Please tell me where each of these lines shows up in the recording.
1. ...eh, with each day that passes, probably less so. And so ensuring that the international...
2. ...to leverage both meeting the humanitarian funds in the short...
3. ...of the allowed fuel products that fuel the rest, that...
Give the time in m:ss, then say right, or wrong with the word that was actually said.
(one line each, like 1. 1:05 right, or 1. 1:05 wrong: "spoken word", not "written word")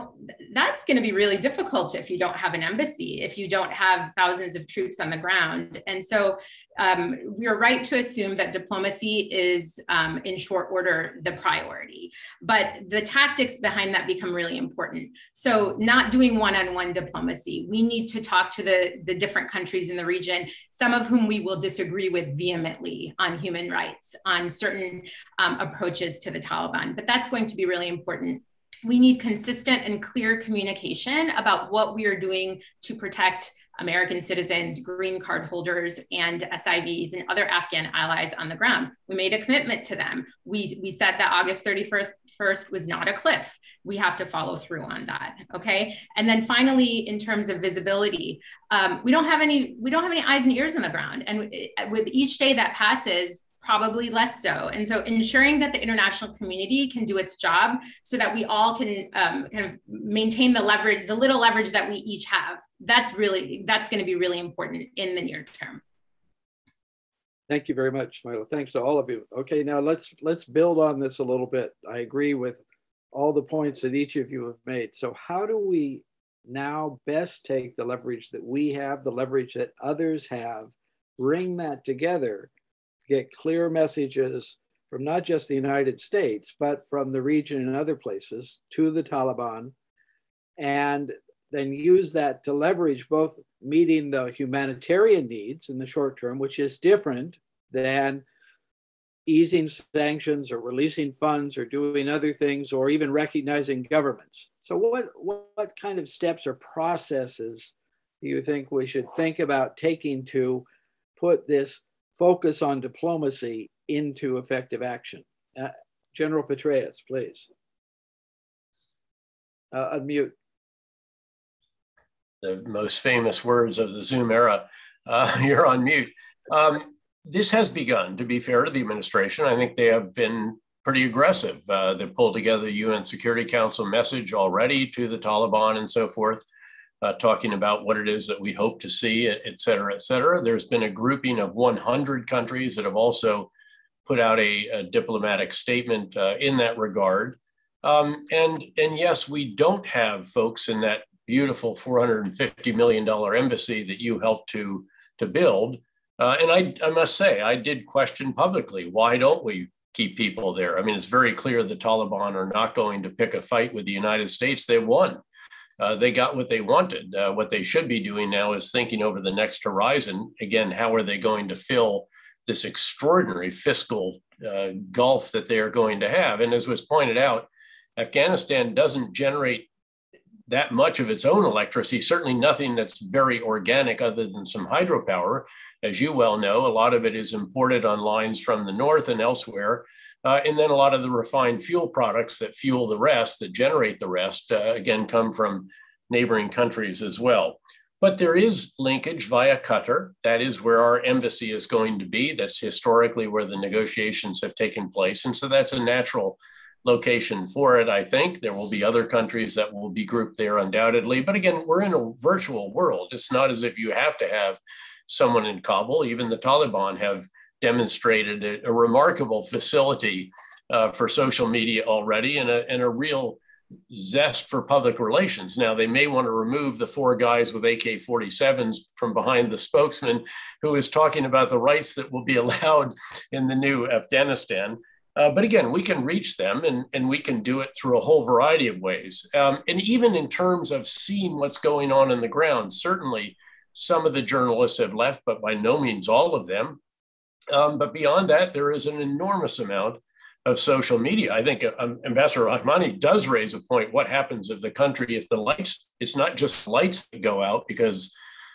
1. 0:51 right
2. 1:32 wrong: "needs", not "funds"
3. 3:10 wrong: "refined", not "allowed".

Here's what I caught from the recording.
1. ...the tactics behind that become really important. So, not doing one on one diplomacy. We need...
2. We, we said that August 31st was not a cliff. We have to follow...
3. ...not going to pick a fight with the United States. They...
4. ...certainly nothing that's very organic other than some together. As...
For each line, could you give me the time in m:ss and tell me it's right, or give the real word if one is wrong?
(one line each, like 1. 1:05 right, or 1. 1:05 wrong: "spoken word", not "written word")
1. 0:12 right
2. 0:40 right
3. 2:42 right
4. 3:02 wrong: "hydropower", not "together".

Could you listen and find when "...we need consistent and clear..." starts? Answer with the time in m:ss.
0:28.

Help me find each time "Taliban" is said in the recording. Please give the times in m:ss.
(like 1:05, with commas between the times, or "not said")
0:26, 1:29, 2:15, 2:41, 3:36.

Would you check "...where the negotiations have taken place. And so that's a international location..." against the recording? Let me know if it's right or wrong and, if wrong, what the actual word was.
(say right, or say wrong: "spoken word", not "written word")
wrong: "natural", not "international".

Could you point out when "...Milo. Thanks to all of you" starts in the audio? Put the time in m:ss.
1:08.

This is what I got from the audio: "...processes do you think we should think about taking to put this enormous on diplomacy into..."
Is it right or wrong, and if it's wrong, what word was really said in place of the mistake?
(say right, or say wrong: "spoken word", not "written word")
wrong: "focus", not "enormous".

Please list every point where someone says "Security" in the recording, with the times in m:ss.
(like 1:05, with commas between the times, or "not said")
2:13.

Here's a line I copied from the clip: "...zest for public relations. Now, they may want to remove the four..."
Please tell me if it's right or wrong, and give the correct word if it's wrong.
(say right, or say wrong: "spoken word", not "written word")
right.